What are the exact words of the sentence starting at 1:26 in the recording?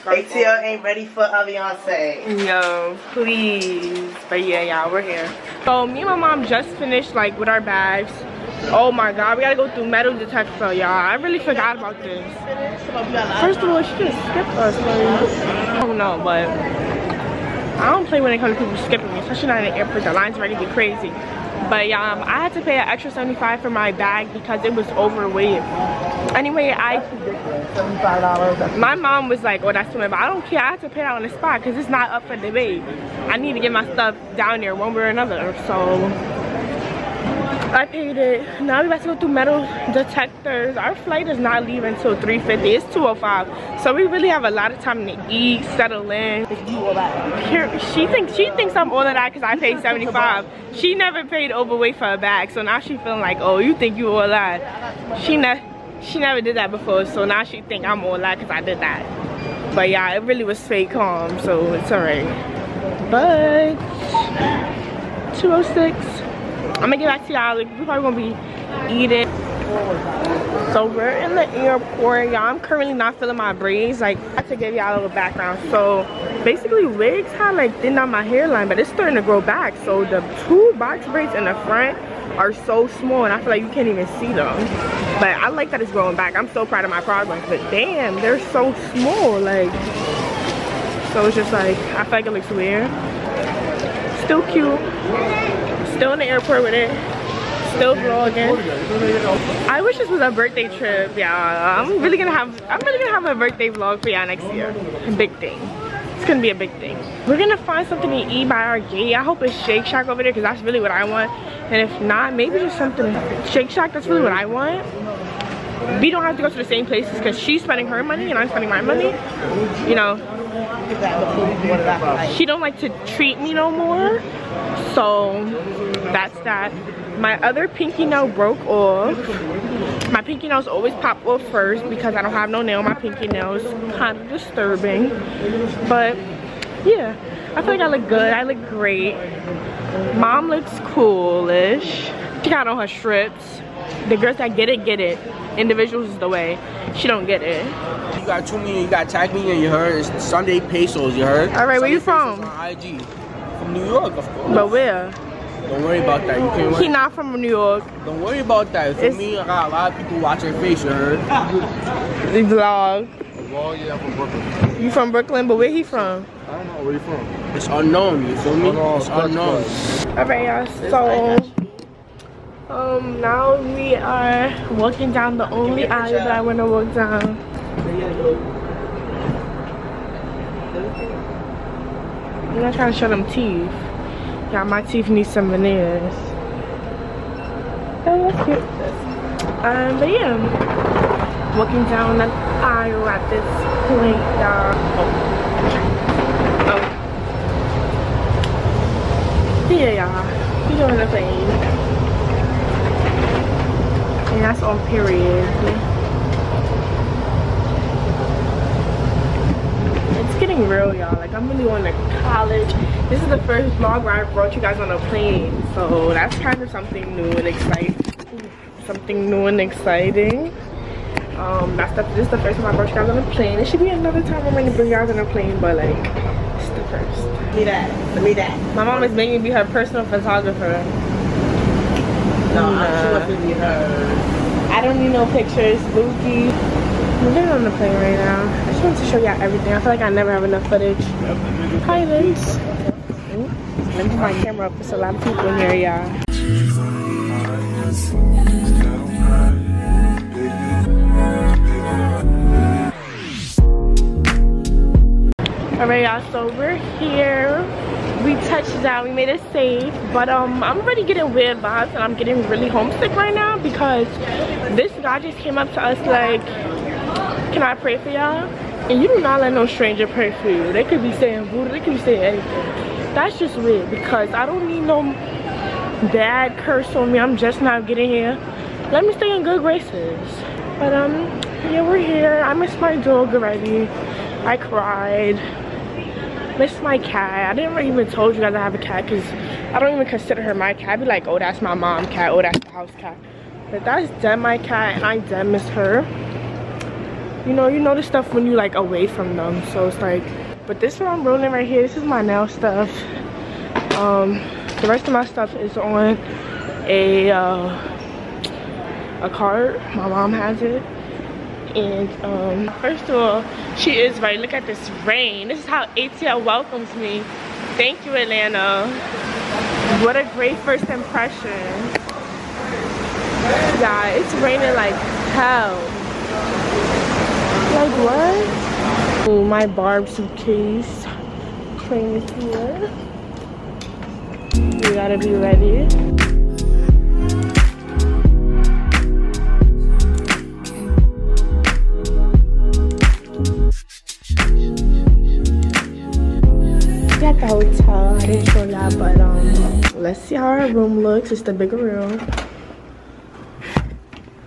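I'm so proud of my progress.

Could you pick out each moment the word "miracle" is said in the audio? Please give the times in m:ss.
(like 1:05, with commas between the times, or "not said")
not said.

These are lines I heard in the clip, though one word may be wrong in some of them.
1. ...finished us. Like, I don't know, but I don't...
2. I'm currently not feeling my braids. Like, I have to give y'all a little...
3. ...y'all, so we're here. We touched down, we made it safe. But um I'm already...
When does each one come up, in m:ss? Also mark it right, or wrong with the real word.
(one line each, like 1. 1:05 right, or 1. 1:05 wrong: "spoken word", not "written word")
1. 0:14 wrong: "skipped", not "finished"
2. 1:12 right
3. 4:16 right.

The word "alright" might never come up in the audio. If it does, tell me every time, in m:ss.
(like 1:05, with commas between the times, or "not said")
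1:01, 2:50, 4:15.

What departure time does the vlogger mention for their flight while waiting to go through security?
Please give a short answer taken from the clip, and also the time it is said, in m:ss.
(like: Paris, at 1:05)
3:50, at 0:42.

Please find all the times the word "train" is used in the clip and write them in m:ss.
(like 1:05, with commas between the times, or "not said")
5:31.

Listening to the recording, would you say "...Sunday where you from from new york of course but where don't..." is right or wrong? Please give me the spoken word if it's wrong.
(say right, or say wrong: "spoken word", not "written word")
right.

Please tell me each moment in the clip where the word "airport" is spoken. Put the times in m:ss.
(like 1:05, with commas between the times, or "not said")
0:19, 1:11, 1:36.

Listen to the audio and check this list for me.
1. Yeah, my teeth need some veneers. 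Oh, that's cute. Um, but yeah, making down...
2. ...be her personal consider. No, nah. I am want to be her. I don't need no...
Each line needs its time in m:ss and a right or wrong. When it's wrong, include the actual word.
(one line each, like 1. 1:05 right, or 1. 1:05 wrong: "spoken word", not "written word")
1. 3:04 wrong: "walking", not "making"
2. 3:49 wrong: "photographer", not "consider".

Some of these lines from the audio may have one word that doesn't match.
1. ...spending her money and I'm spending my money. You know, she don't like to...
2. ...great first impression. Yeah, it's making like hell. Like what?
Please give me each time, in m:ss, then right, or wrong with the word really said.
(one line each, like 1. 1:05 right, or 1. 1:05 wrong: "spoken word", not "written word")
1. 1:57 right
2. 5:20 wrong: "raining", not "making".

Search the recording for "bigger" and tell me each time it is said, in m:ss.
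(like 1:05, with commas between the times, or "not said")
5:51.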